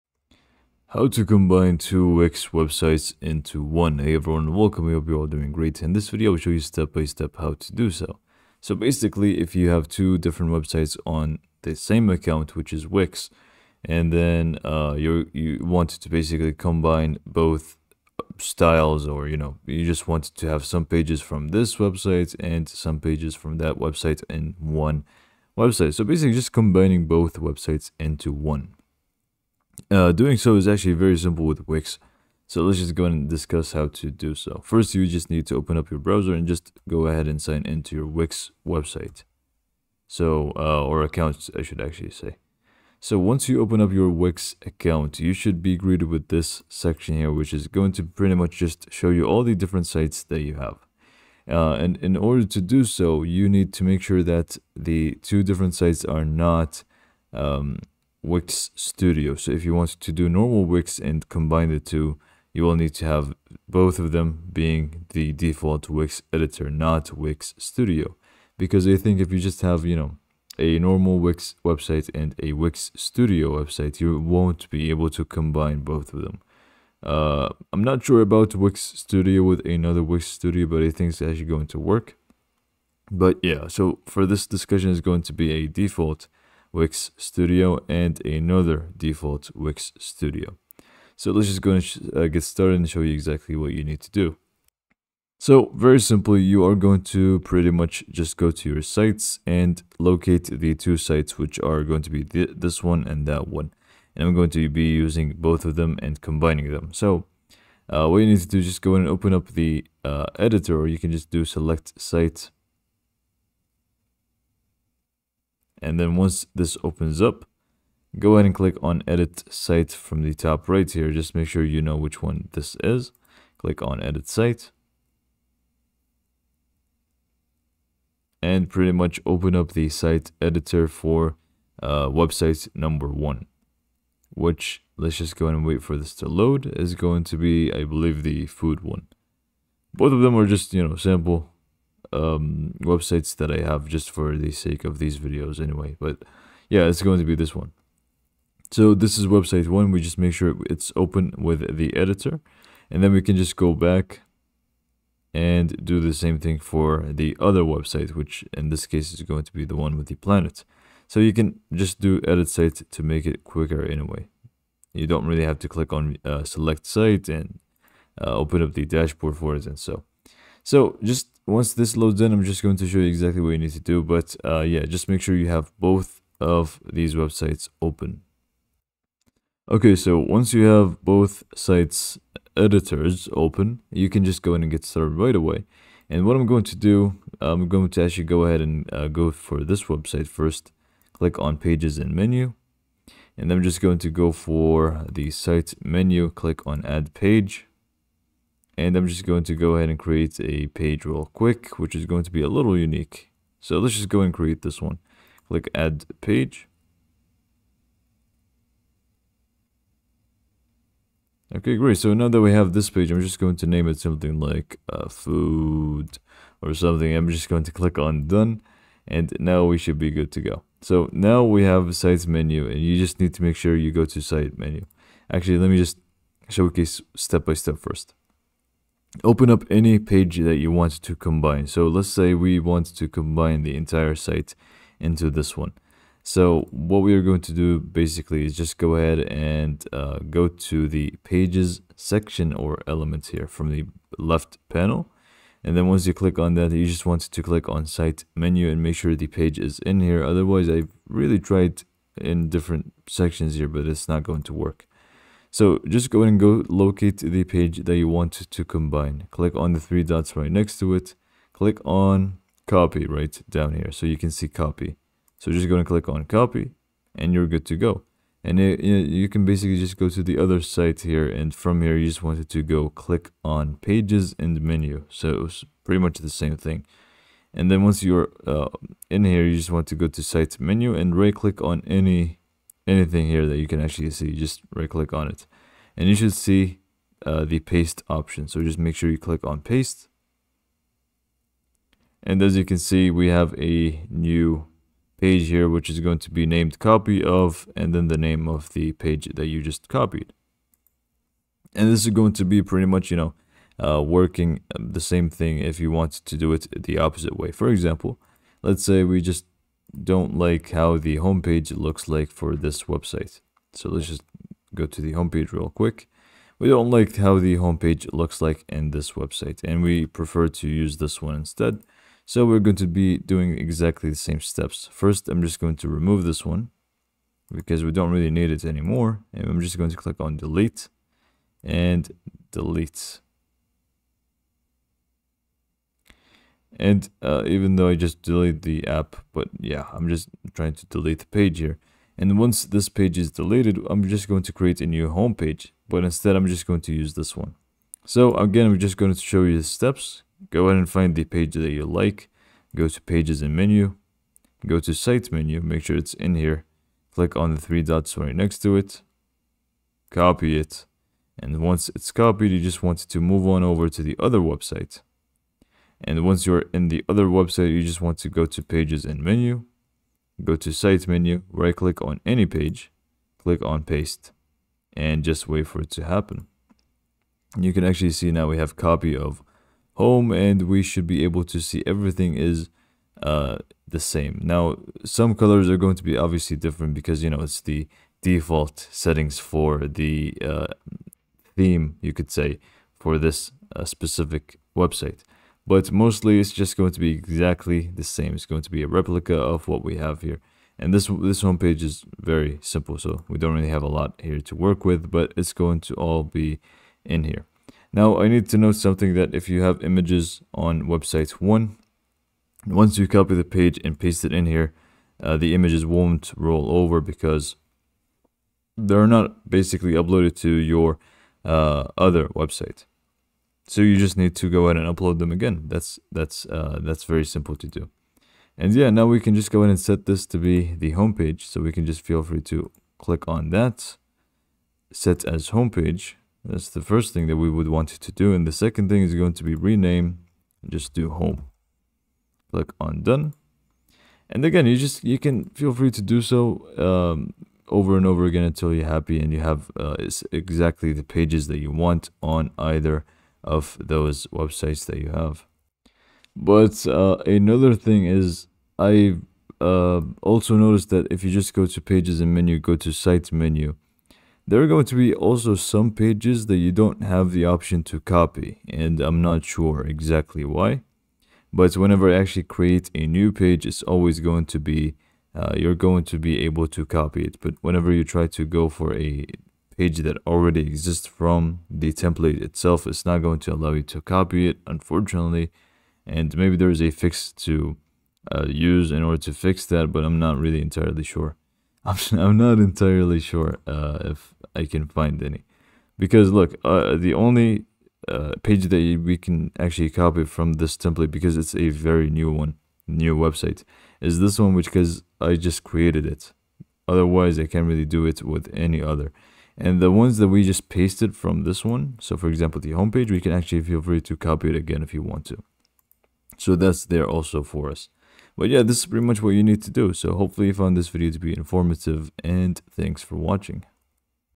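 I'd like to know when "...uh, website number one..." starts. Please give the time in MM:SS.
02:11.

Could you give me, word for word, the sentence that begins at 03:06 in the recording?
And what I'm going to do, I'm going to actually go ahead and uh, go for this website first.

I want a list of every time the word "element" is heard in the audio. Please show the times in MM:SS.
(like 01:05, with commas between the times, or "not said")
04:02.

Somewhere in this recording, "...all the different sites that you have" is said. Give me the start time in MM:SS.
00:49.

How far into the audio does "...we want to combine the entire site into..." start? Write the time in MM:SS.
03:52.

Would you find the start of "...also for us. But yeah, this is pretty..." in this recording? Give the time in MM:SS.
08:37.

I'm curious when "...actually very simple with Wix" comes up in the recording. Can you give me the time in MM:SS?
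00:30.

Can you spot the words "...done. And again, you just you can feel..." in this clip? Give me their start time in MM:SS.
07:23.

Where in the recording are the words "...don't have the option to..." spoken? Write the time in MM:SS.
07:46.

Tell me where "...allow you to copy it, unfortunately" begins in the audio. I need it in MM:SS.
08:03.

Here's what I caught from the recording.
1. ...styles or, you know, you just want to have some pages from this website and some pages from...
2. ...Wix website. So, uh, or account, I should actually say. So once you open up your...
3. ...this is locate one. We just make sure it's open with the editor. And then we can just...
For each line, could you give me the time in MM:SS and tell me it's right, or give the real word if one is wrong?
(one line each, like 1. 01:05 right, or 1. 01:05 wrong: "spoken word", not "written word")
1. 00:18 right
2. 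00:38 right
3. 02:28 wrong: "website", not "locate".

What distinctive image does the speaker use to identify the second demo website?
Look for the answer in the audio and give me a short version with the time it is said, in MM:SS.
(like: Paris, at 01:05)
the planet, at 02:39.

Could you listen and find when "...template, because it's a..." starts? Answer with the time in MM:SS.
08:20.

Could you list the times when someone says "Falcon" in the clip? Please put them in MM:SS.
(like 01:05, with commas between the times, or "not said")
not said.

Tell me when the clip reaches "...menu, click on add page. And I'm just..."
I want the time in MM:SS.
03:15.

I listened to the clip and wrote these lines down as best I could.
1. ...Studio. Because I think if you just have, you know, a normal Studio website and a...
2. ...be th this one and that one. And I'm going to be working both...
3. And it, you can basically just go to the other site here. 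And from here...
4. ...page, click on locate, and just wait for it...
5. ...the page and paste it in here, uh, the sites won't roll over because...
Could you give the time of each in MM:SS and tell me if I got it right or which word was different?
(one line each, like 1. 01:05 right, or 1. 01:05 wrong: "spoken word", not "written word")
1. 01:07 wrong: "Wix", not "Studio"
2. 01:42 wrong: "using", not "working"
3. 04:28 right
4. 06:12 wrong: "paste", not "locate"
5. 06:53 wrong: "images", not "sites".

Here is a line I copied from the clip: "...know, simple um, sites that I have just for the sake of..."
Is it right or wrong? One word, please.
wrong.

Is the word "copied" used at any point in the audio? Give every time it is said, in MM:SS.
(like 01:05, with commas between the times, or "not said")
04:59, 06:02.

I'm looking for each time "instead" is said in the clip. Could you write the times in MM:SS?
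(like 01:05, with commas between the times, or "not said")
05:21, 05:46.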